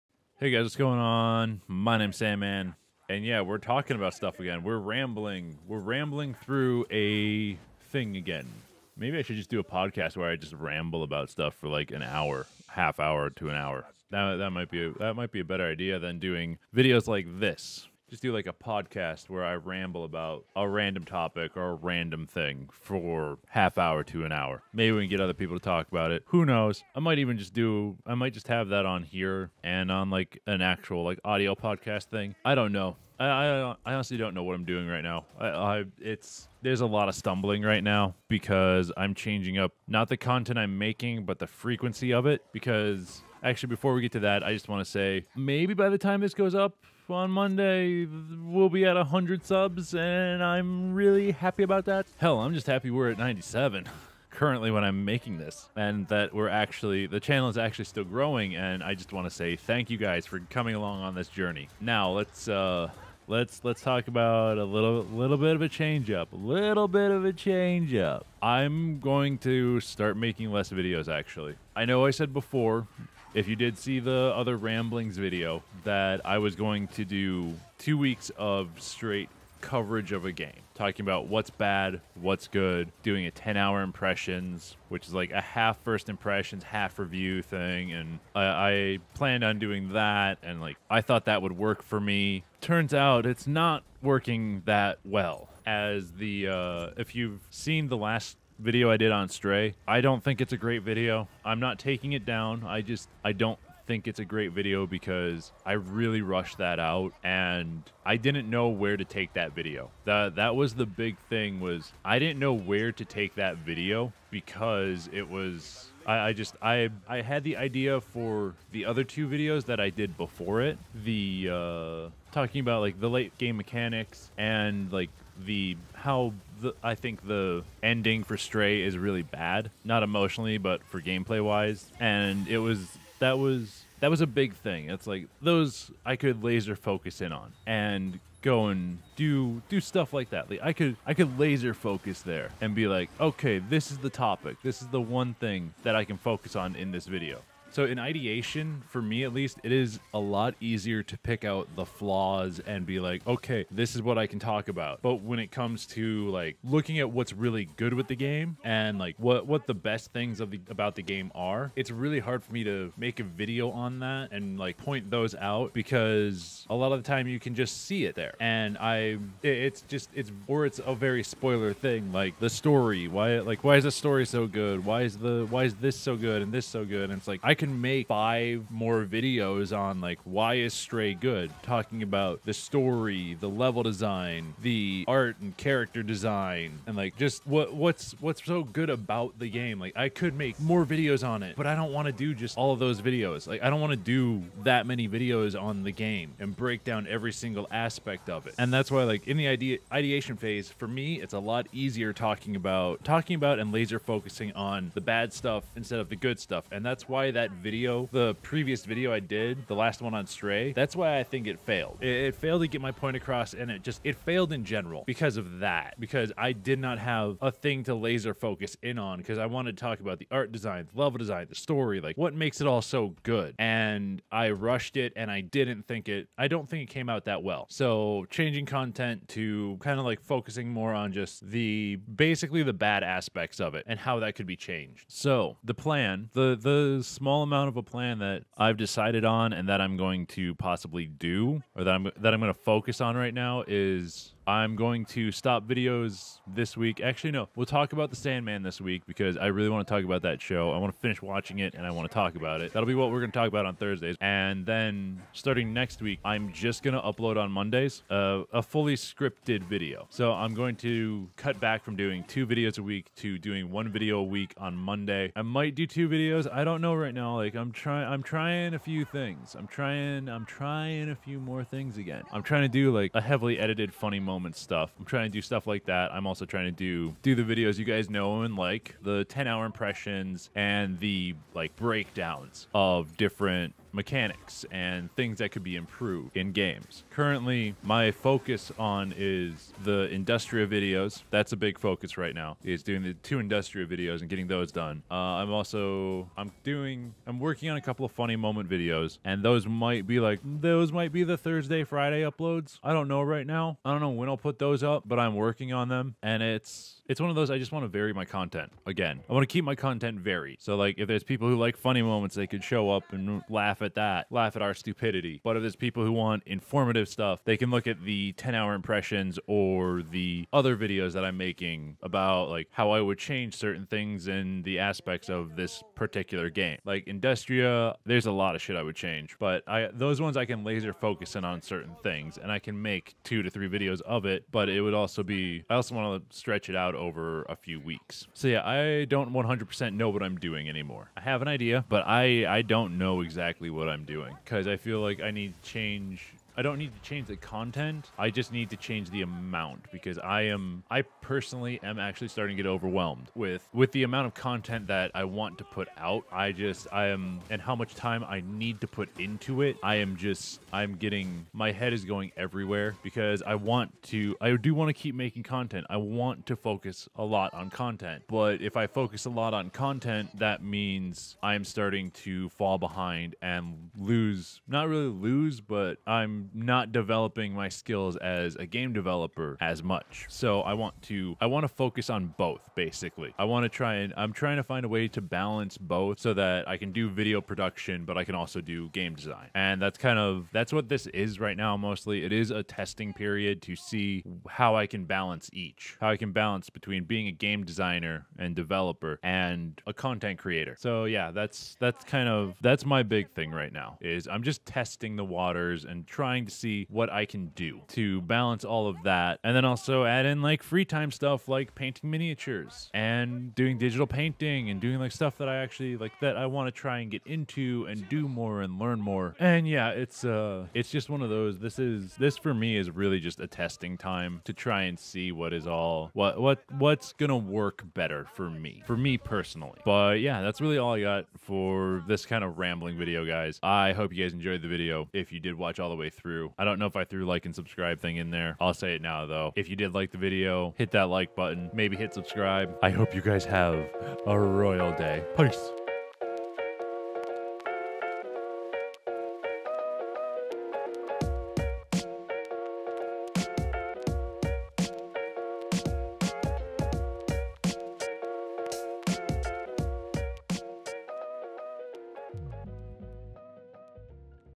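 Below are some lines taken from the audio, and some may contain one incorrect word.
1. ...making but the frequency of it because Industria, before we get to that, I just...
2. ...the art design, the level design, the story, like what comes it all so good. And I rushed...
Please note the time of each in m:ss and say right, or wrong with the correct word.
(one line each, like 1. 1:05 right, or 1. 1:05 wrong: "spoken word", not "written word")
1. 0:40 wrong: "Actually", not "Industria"
2. 3:40 wrong: "makes", not "comes".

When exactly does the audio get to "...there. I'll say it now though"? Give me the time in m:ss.
7:18.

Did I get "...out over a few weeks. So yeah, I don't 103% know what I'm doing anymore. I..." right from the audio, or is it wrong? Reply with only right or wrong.
wrong.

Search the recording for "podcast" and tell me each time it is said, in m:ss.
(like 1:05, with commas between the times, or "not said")
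0:09, 0:18, 0:31.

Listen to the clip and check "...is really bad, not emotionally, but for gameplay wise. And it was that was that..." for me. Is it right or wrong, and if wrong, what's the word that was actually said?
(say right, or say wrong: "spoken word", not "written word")
right.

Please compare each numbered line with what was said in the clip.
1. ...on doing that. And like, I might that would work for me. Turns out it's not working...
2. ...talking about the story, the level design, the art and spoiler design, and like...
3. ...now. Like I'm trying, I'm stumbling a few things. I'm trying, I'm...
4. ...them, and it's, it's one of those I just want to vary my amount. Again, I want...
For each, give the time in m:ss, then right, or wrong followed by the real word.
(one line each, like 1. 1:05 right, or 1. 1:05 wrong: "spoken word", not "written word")
1. 1:29 wrong: "thought", not "might"
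2. 3:01 wrong: "character", not "spoiler"
3. 4:27 wrong: "trying", not "stumbling"
4. 5:05 wrong: "content", not "amount".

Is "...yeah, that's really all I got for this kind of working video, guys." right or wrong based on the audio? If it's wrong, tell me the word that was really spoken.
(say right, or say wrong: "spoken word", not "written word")
wrong: "rambling", not "working".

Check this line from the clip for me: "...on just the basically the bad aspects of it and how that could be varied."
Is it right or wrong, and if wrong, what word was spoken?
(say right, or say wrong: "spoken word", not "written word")
wrong: "changed", not "varied".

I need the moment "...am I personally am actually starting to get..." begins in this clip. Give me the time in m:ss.
5:50.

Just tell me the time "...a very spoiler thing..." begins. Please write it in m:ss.
2:50.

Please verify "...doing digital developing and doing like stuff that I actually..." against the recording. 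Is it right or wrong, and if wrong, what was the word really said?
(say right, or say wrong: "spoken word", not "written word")
wrong: "painting", not "developing".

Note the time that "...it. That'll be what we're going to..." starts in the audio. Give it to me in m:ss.
4:12.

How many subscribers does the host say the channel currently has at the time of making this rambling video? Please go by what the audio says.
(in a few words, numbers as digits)
97.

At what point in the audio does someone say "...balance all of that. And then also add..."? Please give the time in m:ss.
6:48.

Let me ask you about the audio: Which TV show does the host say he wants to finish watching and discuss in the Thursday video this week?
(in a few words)
The Sandman.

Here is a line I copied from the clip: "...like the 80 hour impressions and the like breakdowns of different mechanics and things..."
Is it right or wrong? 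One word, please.
wrong.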